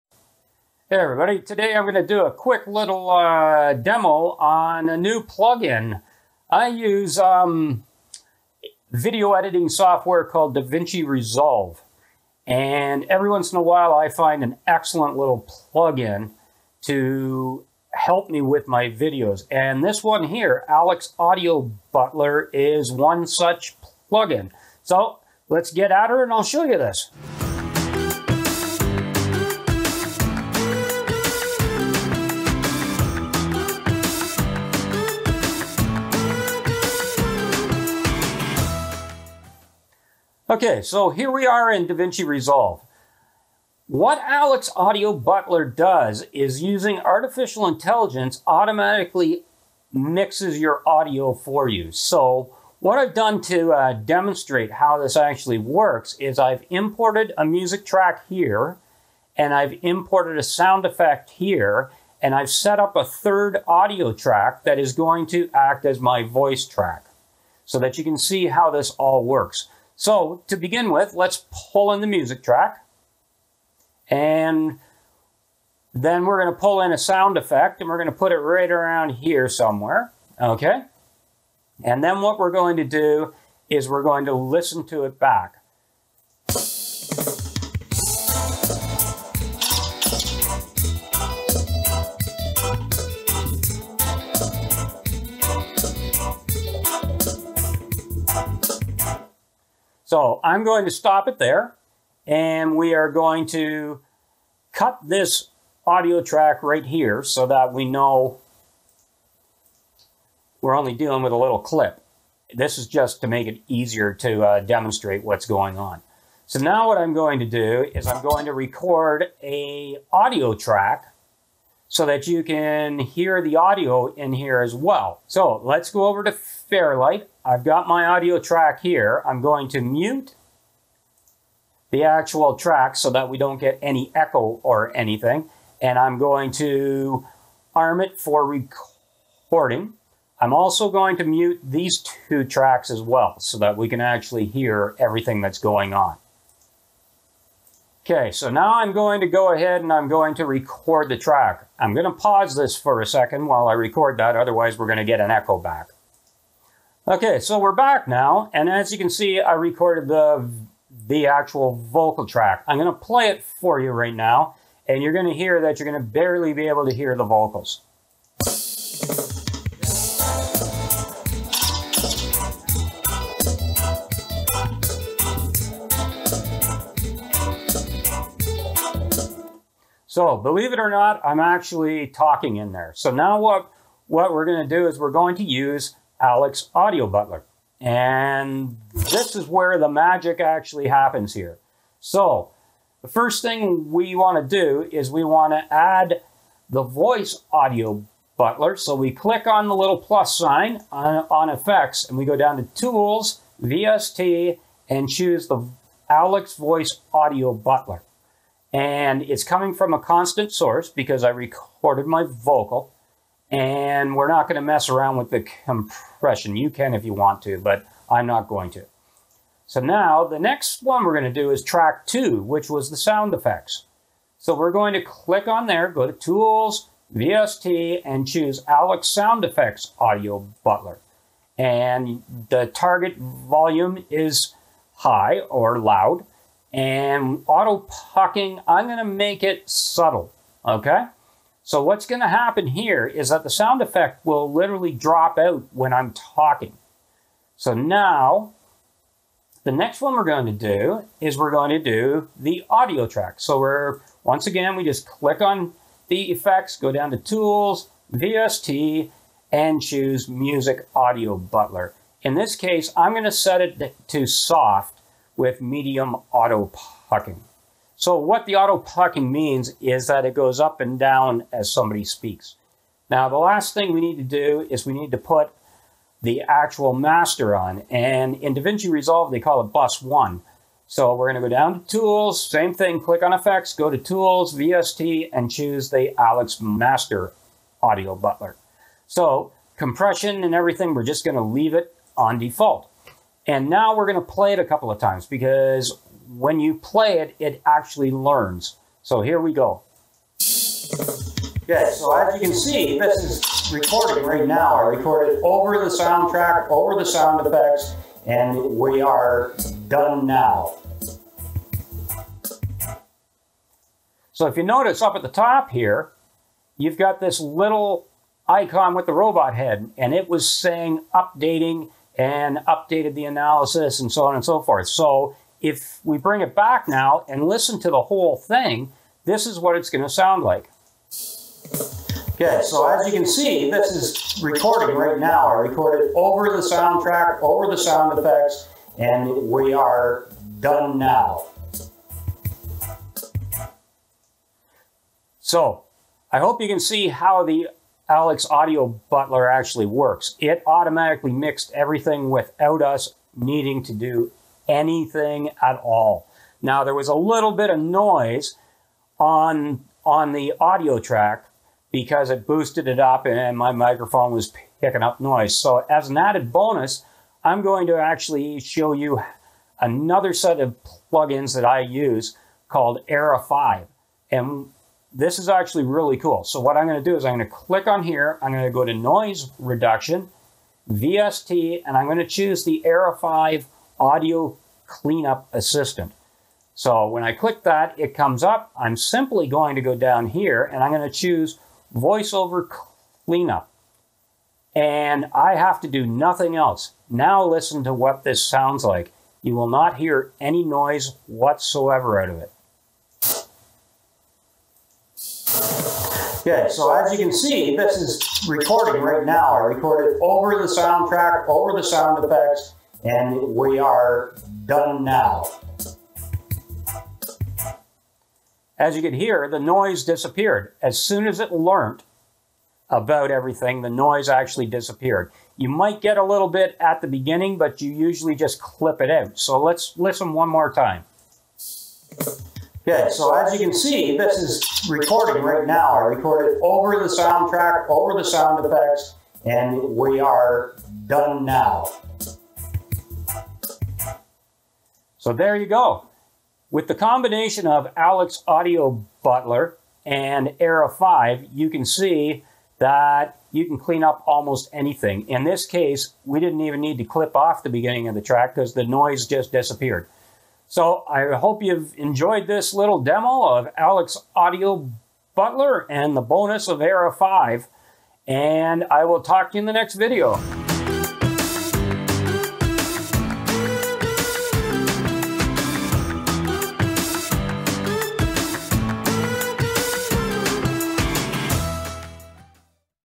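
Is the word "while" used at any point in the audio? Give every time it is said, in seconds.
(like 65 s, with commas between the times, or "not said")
13 s, 153 s.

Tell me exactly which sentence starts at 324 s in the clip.
So if we bring it back now and listen to the whole thing, this is what it's going to sound like.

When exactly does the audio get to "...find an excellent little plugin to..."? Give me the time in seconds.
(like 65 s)
14 s.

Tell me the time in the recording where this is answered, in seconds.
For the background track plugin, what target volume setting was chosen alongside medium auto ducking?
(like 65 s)
264 s.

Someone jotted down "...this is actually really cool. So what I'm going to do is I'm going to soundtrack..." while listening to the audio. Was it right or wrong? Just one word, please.
wrong.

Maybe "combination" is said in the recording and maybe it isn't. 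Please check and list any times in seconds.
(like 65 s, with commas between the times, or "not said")
446 s.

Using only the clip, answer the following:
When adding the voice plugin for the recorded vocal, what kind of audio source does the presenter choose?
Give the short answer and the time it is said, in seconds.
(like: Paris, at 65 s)
constant source, at 209 s.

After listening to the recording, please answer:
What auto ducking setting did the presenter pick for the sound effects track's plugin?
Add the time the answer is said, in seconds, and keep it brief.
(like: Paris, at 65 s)
subtle, at 239 s.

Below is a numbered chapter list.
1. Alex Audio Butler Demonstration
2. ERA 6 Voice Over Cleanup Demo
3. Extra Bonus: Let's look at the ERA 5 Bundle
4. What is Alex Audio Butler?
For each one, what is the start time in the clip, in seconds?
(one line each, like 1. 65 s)
1. 55 s
2. 401 s
3. 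366 s
4. 40 s.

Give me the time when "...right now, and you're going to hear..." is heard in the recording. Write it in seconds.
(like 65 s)
163 s.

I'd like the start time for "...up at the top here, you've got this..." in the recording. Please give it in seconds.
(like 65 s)
315 s.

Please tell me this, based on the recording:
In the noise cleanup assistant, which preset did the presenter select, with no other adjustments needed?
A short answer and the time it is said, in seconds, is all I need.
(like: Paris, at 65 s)
voiceover cleanup, at 391 s.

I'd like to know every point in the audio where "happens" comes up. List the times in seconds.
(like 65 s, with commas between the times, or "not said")
190 s, 242 s.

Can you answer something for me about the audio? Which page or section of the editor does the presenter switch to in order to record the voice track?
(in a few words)
Fairlight.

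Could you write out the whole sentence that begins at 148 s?
Okay, so now I'm going to go ahead and I'm going to record the track.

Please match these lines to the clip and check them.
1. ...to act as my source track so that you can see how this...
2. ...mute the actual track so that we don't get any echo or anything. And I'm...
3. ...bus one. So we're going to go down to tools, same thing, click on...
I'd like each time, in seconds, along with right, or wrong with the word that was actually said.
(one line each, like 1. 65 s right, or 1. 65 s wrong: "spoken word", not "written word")
1. 65 s wrong: "voice", not "source"
2. 129 s right
3. 279 s right.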